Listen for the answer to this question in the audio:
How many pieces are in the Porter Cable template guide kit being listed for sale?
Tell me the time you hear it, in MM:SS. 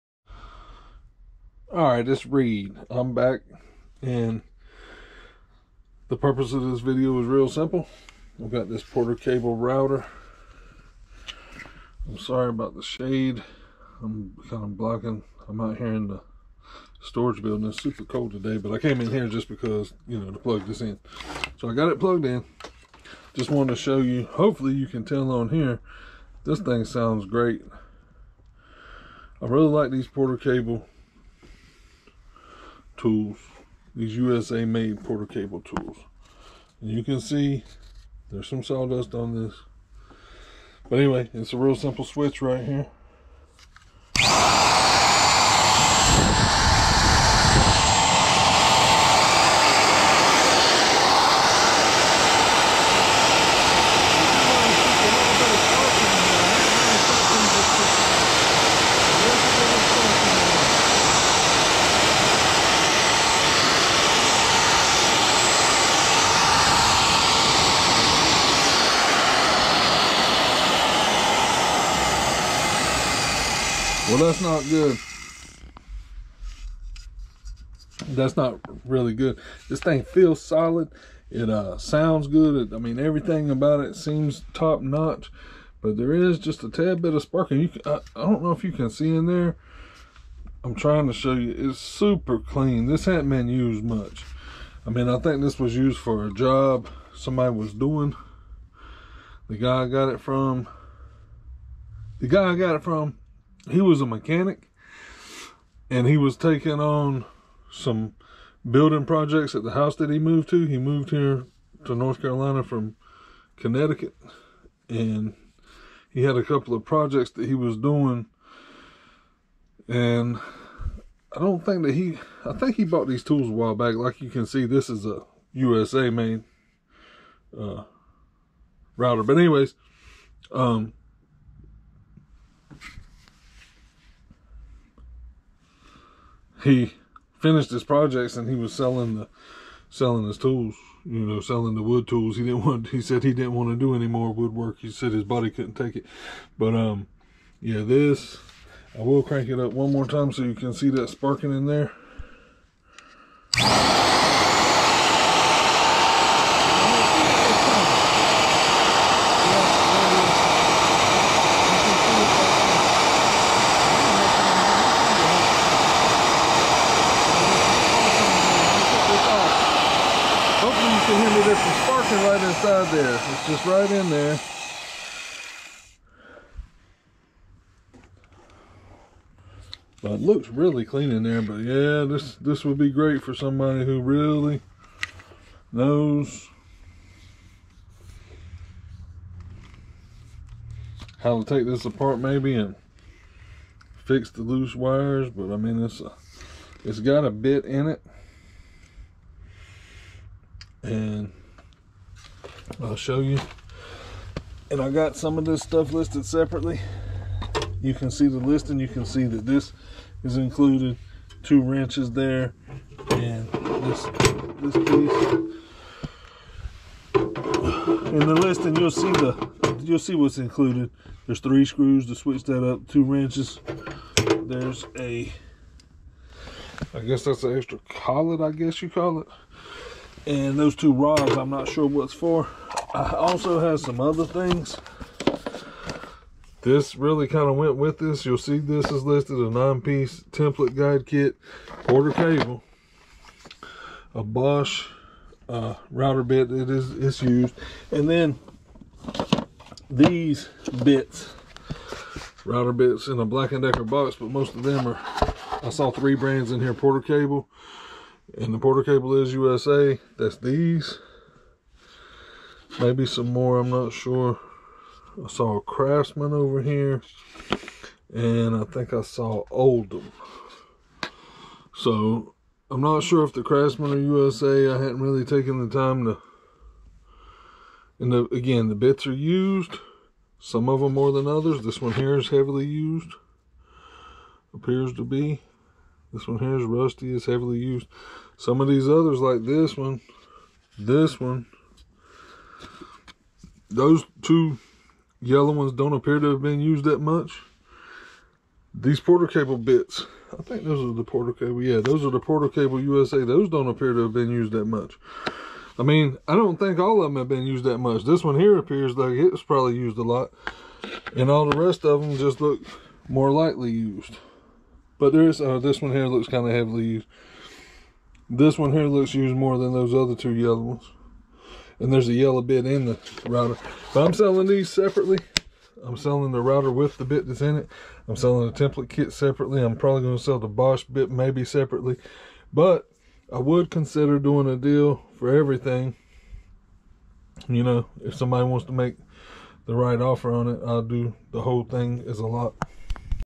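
03:59.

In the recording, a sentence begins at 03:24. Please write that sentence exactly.
And I got some of this stuff listed separately.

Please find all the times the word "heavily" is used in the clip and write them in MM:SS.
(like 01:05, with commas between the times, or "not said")
04:42, 04:47, 05:16.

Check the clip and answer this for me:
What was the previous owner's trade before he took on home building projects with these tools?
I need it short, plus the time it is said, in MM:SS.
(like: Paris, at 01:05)
mechanic, at 01:44.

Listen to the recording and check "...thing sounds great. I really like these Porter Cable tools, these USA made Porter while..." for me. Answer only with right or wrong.
wrong.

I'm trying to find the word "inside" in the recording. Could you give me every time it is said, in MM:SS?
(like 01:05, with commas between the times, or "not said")
02:52.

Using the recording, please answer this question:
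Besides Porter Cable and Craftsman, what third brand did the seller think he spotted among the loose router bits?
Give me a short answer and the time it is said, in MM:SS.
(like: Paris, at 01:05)
Oldham, at 04:29.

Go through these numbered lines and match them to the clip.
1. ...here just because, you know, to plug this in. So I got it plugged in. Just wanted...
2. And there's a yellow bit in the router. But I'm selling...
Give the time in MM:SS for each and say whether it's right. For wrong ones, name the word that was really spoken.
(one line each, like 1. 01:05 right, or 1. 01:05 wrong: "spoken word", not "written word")
1. 00:19 right
2. 05:21 right.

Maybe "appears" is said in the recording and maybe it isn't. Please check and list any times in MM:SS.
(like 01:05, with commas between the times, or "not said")
04:44, 04:55, 05:03, 05:08.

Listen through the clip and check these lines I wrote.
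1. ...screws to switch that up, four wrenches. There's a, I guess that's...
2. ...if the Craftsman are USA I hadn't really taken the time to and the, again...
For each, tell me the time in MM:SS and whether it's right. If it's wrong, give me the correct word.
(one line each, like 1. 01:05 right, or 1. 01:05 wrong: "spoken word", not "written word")
1. 03:41 wrong: "two", not "four"
2. 04:33 right.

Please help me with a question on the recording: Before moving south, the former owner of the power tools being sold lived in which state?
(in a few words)
Connecticut.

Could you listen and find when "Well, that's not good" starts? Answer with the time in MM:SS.
01:14.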